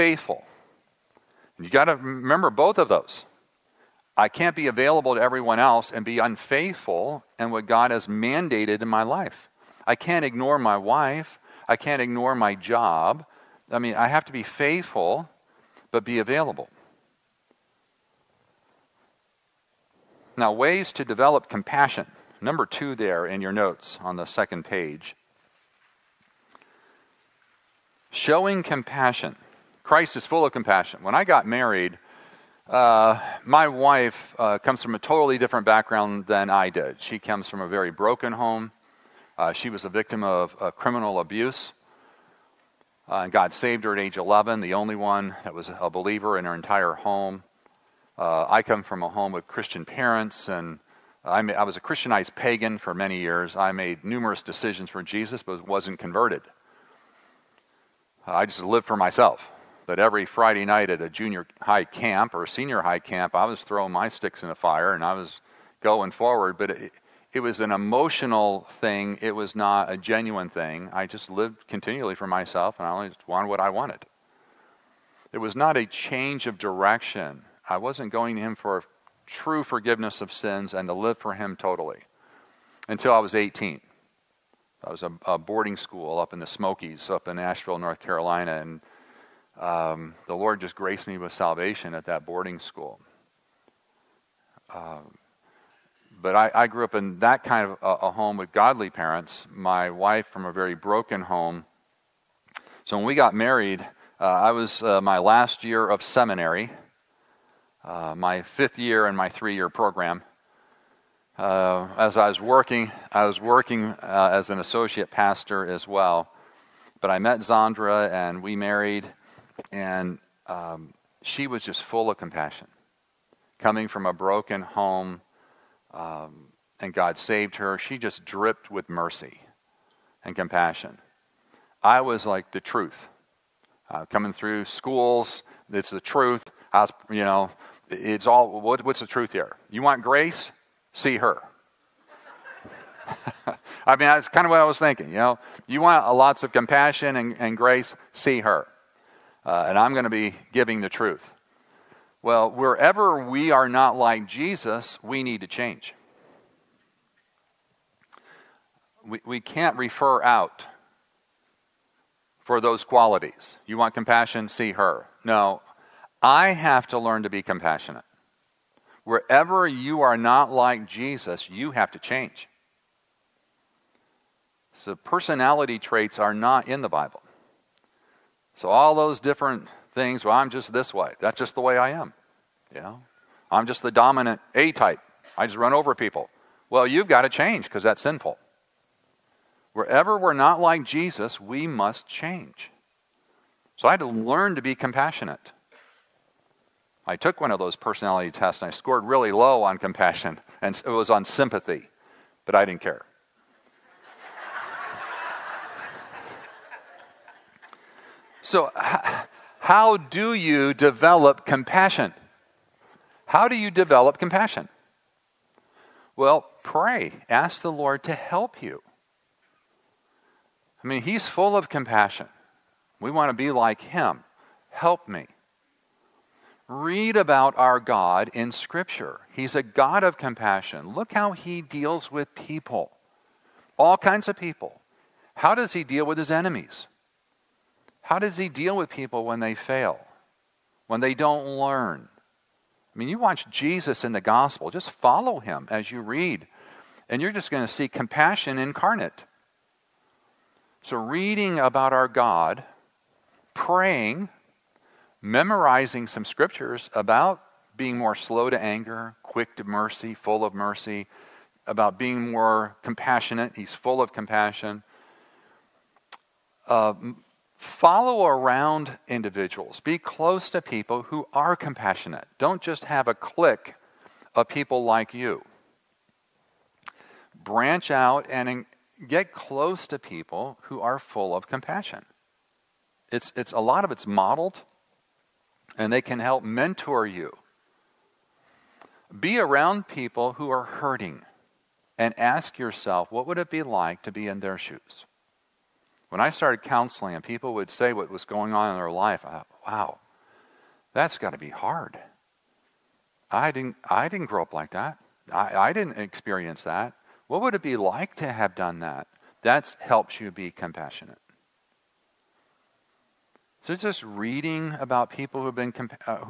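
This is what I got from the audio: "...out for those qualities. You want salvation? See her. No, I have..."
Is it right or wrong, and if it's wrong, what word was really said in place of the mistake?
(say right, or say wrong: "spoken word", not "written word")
wrong: "compassion", not "salvation".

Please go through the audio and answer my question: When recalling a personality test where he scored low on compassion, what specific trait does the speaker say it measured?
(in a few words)
sympathy.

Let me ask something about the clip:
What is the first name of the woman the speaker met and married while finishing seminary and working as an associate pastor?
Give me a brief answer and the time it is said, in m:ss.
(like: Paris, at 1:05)
Zandra, at 1:57.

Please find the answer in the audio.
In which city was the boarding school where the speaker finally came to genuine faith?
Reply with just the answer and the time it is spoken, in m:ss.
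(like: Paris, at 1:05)
Asheville, North Carolina, at 1:27.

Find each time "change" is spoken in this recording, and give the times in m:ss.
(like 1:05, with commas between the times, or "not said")
1:15, 2:35, 2:51, 3:07, 3:12.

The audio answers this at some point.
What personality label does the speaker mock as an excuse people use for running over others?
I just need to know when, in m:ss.
3:03.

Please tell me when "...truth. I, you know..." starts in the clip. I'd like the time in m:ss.
2:16.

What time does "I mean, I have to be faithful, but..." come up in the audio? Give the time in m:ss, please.
0:13.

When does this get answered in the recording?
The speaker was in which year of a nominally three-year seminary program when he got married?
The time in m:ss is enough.
1:48.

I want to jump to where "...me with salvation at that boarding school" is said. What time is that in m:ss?
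1:31.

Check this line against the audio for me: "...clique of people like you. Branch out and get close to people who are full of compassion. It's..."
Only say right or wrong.
right.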